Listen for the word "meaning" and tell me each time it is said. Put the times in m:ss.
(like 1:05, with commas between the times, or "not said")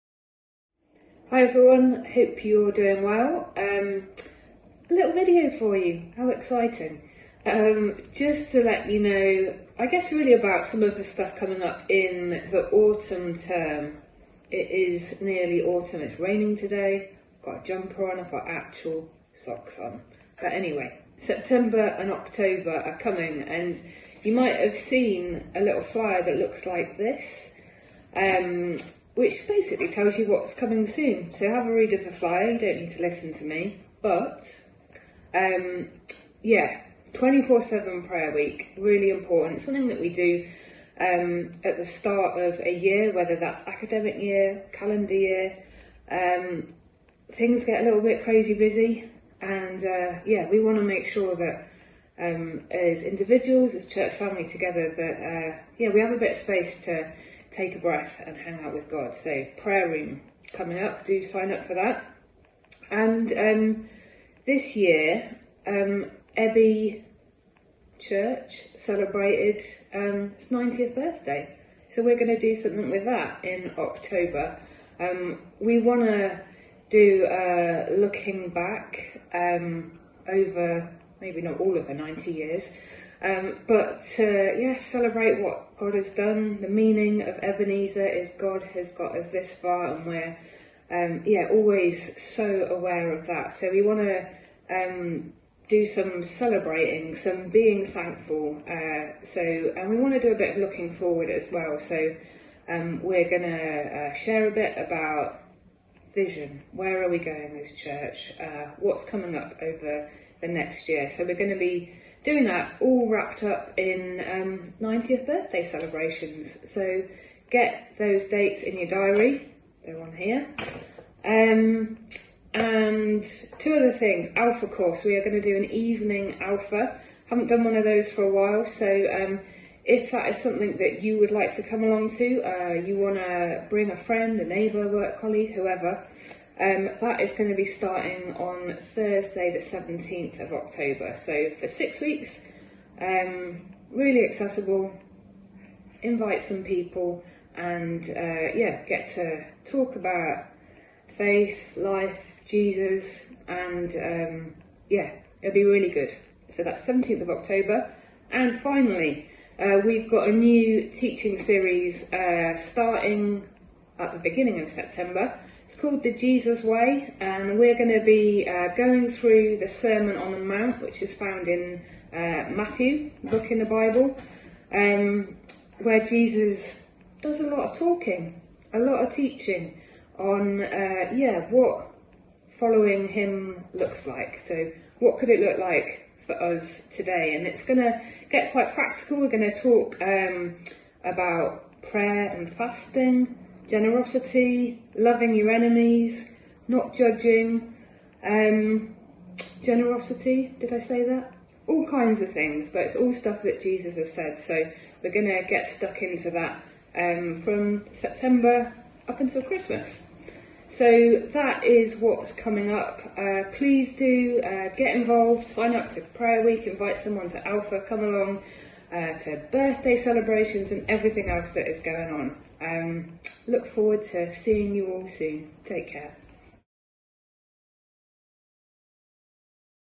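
1:26.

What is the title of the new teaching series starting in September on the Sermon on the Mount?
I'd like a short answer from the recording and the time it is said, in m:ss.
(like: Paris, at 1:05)
The Jesus Way, at 2:46.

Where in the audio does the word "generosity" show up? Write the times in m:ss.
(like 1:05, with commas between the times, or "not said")
3:13, 3:19.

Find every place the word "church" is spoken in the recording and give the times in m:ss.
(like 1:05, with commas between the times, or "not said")
0:53, 1:07, 1:47.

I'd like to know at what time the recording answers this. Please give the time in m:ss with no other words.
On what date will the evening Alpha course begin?
2:18.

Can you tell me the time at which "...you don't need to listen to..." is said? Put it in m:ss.
0:32.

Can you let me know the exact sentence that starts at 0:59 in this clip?
So, prayer room coming up, do sign up for that.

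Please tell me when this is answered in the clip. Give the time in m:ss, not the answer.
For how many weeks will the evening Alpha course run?
2:21.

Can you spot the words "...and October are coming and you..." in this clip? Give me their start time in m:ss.
0:21.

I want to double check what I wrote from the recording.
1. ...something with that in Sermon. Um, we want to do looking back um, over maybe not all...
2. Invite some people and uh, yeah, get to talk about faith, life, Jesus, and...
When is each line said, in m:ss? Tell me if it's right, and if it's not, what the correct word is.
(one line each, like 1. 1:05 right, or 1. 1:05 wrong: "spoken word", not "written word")
1. 1:12 wrong: "October", not "Sermon"
2. 2:26 right.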